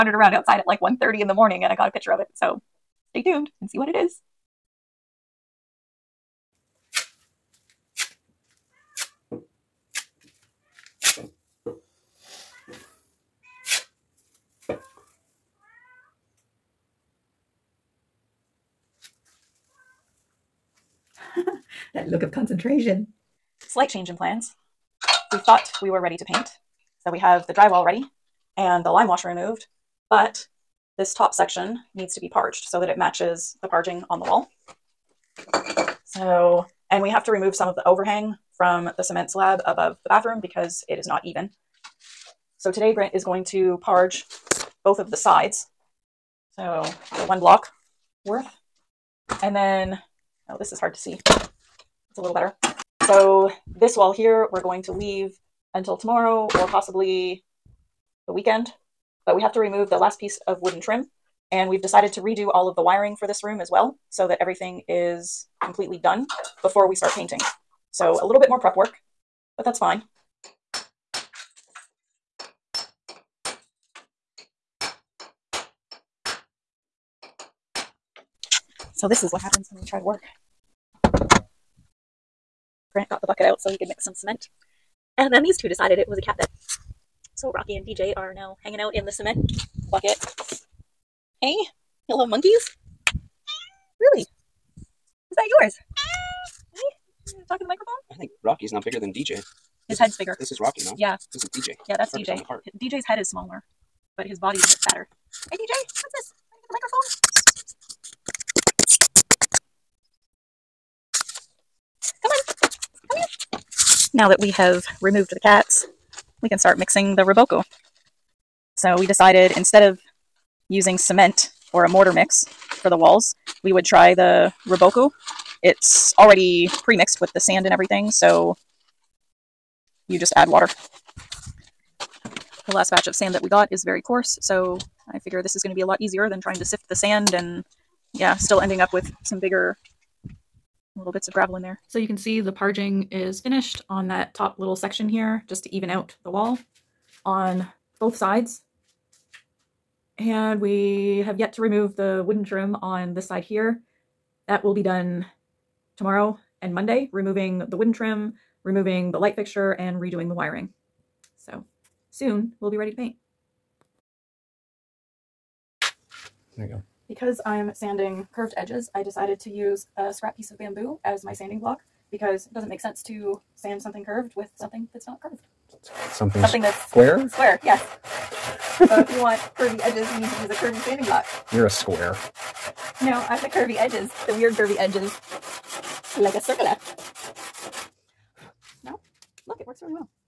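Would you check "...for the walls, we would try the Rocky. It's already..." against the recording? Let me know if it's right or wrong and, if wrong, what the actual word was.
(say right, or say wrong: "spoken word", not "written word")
wrong: "Reboco", not "Rocky".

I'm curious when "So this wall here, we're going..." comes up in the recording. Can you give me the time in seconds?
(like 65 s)
53 s.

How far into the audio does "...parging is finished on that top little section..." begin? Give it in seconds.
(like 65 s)
142 s.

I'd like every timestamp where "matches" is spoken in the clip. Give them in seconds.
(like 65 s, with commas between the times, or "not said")
32 s.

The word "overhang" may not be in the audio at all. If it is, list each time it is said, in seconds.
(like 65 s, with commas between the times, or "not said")
37 s.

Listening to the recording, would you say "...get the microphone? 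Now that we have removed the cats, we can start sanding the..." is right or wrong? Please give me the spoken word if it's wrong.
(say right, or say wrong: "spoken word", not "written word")
wrong: "mixing", not "sanding".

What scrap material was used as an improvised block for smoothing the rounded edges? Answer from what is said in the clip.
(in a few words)
Bamboo.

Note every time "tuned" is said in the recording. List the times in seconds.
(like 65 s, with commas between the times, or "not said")
3 s.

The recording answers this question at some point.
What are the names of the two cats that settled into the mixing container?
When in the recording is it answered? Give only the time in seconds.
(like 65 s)
87 s.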